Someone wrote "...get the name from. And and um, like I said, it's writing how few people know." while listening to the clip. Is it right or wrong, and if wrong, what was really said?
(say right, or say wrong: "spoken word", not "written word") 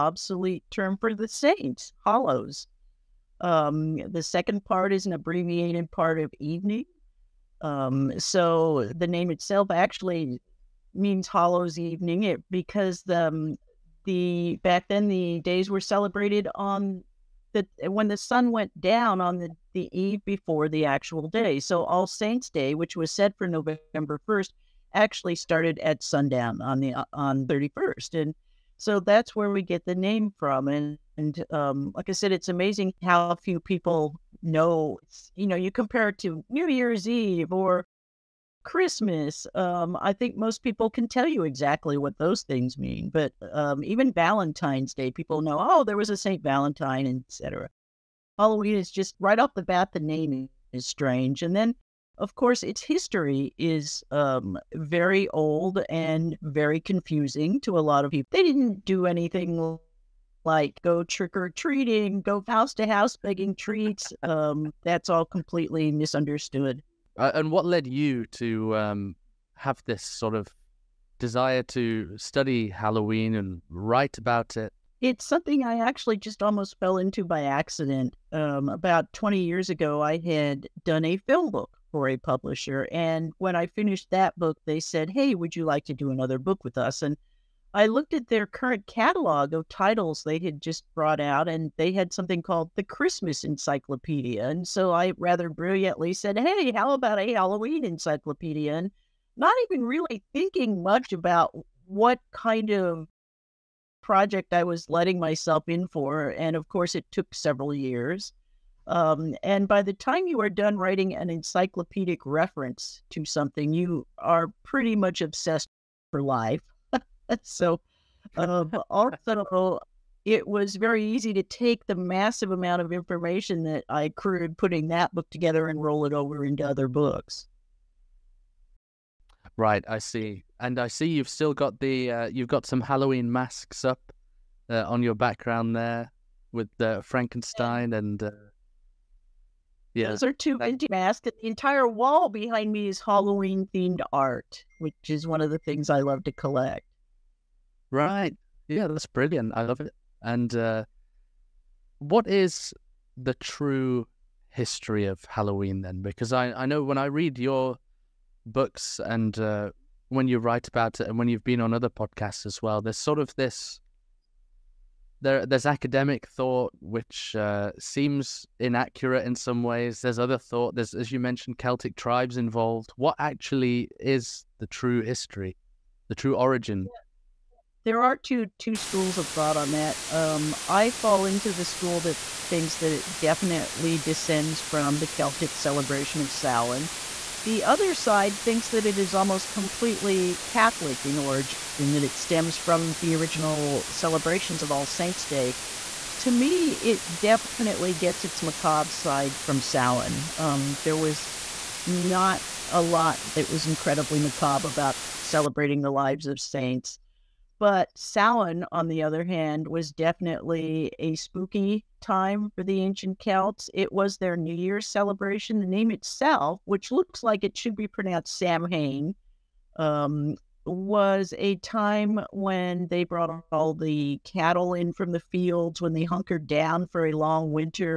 wrong: "amazing", not "writing".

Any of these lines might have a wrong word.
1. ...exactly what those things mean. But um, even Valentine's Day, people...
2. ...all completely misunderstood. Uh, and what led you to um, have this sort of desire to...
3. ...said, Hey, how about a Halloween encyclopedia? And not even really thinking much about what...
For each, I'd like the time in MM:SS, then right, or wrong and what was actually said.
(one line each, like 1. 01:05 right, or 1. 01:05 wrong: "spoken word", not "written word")
1. 00:41 right
2. 01:05 right
3. 01:36 right.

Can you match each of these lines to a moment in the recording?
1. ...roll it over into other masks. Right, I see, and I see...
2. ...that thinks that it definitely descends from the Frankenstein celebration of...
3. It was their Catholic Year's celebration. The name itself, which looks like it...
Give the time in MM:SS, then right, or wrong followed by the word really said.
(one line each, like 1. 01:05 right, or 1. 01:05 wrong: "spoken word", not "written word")
1. 02:05 wrong: "books", not "masks"
2. 03:02 wrong: "Celtic", not "Frankenstein"
3. 03:33 wrong: "New", not "Catholic".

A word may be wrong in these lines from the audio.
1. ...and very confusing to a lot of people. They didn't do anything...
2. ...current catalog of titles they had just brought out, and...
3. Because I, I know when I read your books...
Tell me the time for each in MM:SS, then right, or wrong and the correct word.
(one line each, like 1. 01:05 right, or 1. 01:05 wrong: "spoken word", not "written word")
1. 00:55 right
2. 01:28 right
3. 02:36 right.